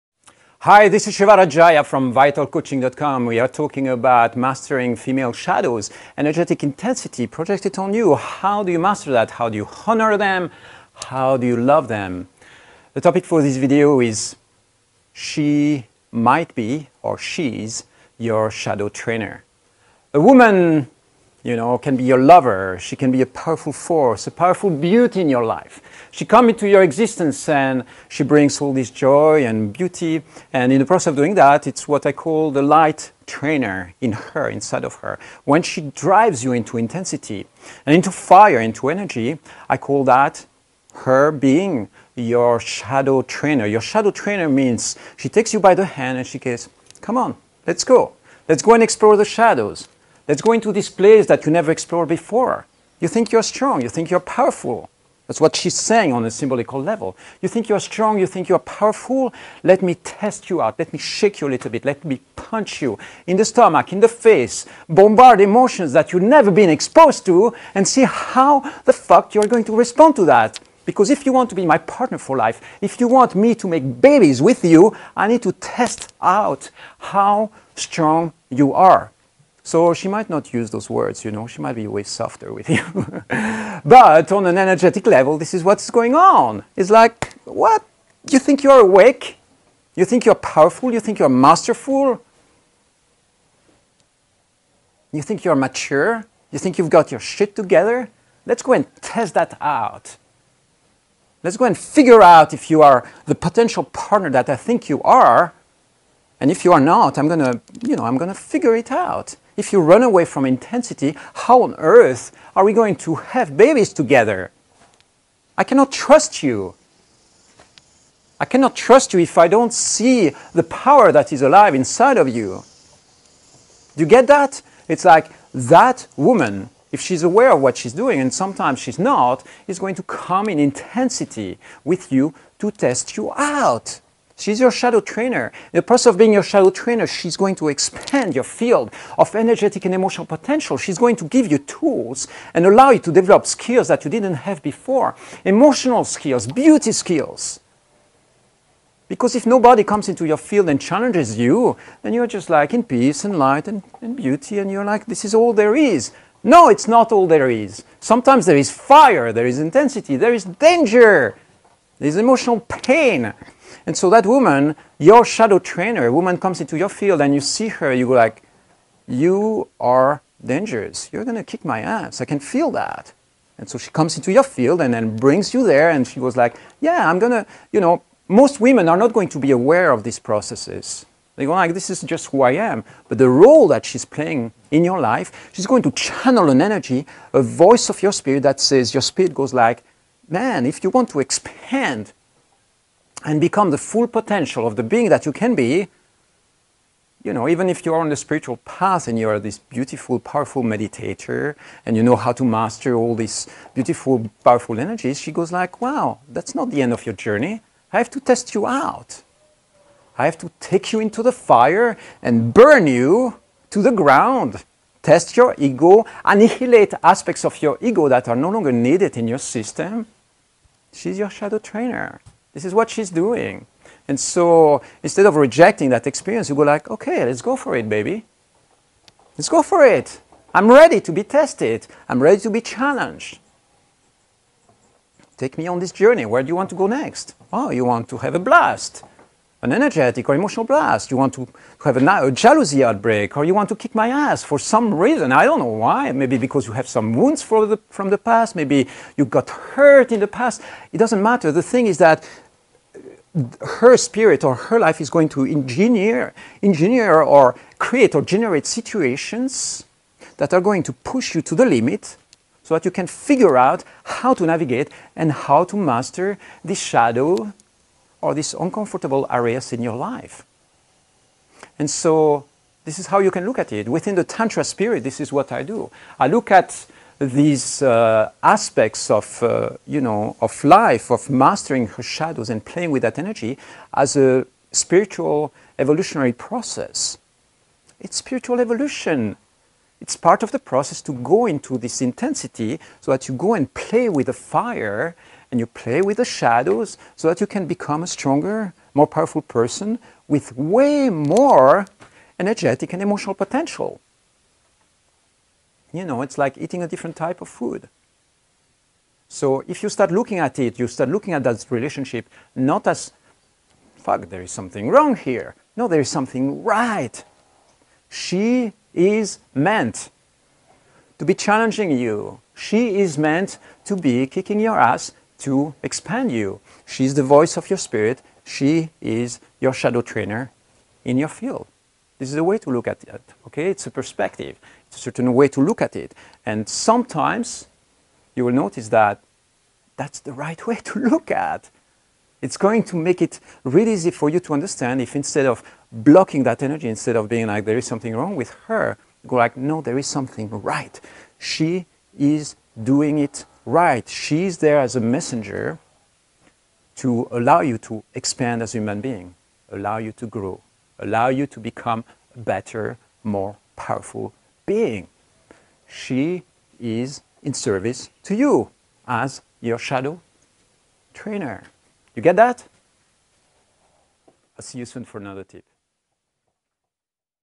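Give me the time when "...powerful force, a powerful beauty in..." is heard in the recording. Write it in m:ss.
0:23.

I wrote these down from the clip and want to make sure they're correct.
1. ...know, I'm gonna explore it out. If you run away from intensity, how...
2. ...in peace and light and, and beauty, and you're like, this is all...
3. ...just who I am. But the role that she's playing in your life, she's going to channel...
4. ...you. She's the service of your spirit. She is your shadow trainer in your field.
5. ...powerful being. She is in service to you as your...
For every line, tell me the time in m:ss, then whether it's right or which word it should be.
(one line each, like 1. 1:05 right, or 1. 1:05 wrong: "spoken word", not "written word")
1. 1:47 wrong: "figure", not "explore"
2. 2:32 right
3. 3:02 right
4. 5:26 wrong: "voice", not "service"
5. 6:03 right.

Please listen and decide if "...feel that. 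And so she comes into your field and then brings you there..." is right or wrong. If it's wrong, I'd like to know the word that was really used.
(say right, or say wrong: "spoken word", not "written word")
right.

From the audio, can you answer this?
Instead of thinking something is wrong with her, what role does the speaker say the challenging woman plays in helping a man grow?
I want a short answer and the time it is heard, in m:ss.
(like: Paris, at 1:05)
messenger, at 5:55.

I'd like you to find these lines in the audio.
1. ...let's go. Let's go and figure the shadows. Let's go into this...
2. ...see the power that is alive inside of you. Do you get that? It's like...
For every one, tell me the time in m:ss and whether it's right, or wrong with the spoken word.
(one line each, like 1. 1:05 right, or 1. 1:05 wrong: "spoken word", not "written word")
1. 0:47 wrong: "explore", not "figure"
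2. 1:59 right.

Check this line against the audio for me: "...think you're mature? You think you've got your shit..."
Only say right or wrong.
right.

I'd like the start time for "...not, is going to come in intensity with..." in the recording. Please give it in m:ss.
2:08.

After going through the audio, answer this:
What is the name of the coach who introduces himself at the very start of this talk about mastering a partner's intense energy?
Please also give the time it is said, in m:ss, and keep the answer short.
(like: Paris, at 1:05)
Shiva Rajaya, at 0:01.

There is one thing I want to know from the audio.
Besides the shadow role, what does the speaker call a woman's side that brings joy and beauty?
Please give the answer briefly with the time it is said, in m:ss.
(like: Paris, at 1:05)
light trainer, at 0:32.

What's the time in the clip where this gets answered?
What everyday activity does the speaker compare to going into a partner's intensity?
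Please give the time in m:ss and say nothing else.
5:06.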